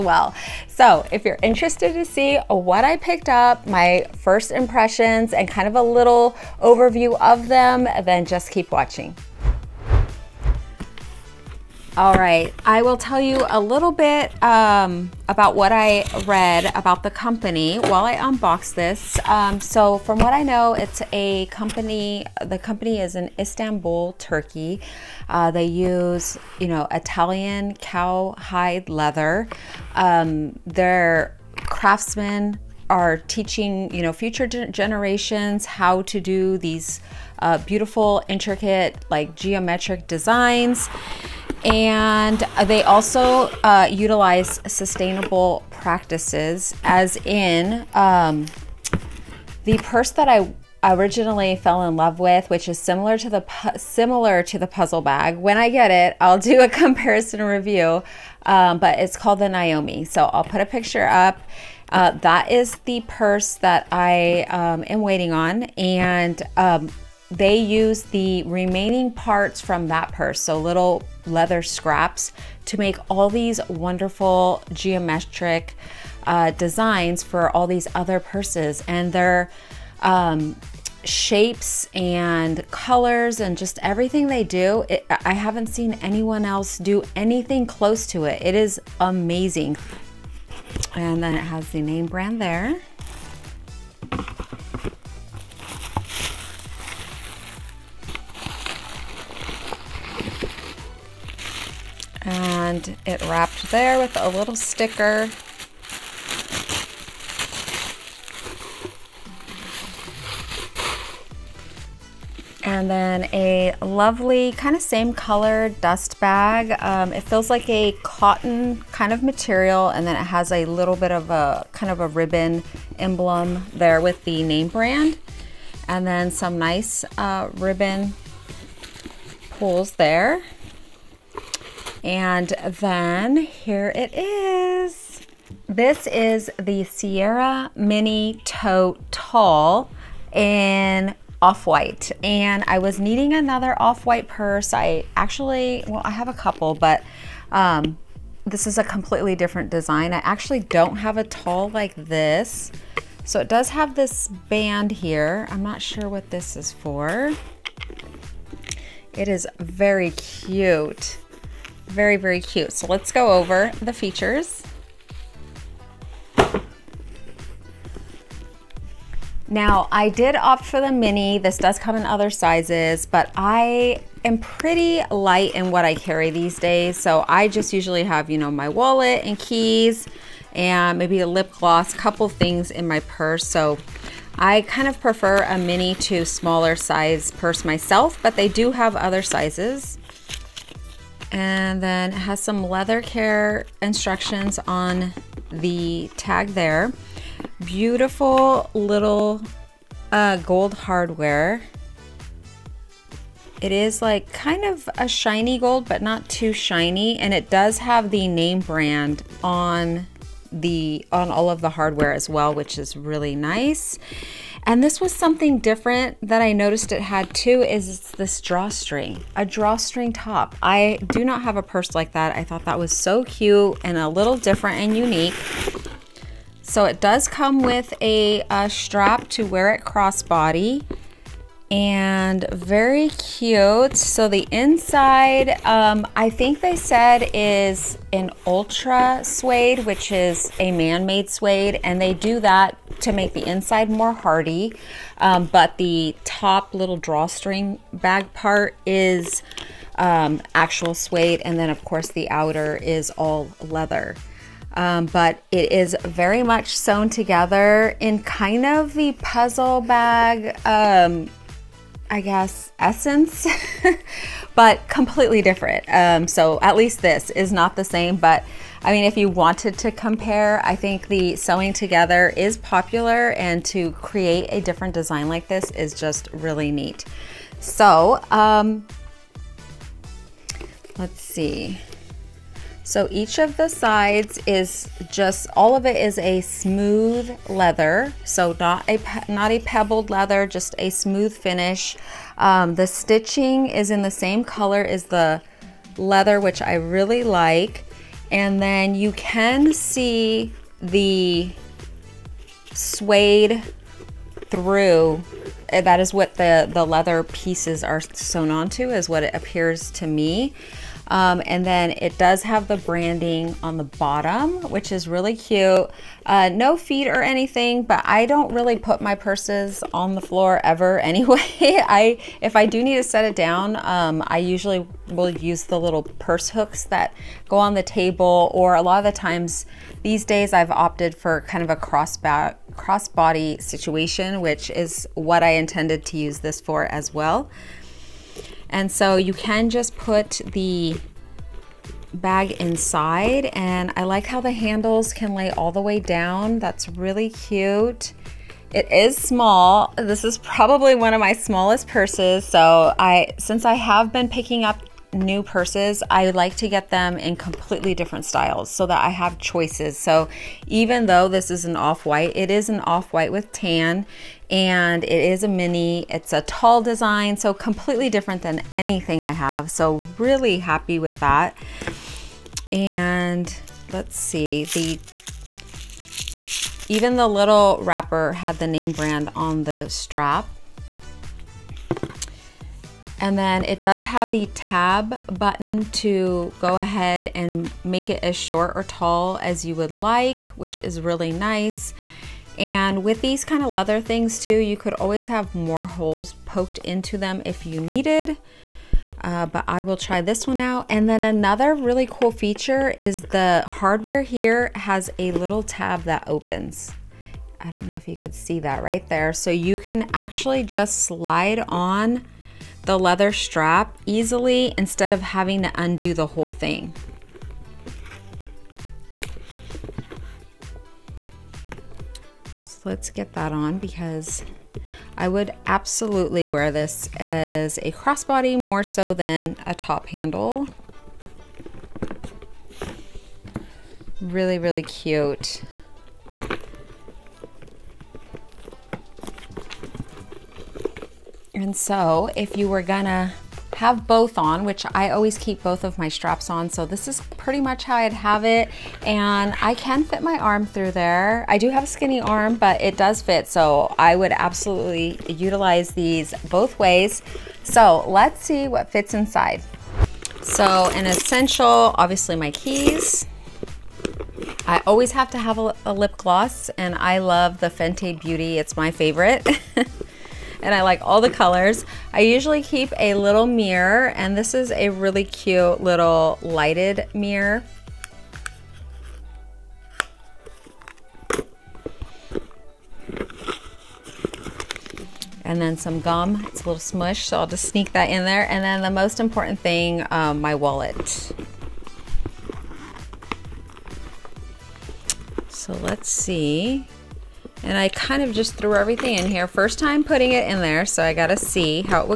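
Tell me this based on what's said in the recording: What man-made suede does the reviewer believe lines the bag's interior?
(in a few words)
ultra suede.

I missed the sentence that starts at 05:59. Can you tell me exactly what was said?
So even though this is an off-white, it is an off-white with tan and it is a mini.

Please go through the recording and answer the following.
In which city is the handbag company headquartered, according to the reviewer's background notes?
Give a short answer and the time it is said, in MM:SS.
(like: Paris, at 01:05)
Istanbul, at 00:23.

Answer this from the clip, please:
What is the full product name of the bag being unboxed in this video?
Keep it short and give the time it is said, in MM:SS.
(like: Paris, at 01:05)
Sera Mini Tote Tall, at 02:16.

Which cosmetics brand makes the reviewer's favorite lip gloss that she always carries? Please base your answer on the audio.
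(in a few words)
Fenty Beauty.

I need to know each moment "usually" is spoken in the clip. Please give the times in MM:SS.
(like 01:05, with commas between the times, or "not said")
02:57, 05:24, 07:52.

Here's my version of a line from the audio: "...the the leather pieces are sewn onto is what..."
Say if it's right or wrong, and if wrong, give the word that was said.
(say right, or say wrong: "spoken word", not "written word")
right.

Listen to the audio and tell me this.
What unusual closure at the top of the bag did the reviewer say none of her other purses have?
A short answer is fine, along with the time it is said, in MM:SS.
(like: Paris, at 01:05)
drawstring top, at 03:39.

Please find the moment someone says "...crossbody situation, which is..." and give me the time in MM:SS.
05:32.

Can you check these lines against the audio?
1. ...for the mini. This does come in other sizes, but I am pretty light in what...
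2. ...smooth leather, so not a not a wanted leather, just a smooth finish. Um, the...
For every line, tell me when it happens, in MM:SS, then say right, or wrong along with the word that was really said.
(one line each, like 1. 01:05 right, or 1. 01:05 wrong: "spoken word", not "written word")
1. 02:50 right
2. 04:46 wrong: "pebbled", not "wanted".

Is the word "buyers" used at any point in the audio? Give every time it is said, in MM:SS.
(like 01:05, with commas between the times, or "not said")
not said.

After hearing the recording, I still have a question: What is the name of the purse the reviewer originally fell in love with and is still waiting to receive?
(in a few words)
Naomi.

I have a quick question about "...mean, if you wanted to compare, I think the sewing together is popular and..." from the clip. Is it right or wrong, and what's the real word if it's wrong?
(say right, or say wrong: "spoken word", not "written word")
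right.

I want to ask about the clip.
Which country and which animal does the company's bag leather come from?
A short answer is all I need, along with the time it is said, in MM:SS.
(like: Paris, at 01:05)
Italian cowhide, at 00:26.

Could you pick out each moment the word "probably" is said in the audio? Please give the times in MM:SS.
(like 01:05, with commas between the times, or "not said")
05:50.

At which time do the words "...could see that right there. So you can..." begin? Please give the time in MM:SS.
06:48.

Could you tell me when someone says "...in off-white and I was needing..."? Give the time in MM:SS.
02:20.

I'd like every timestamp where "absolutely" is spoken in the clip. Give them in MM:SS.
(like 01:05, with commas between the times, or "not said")
07:05, 07:34.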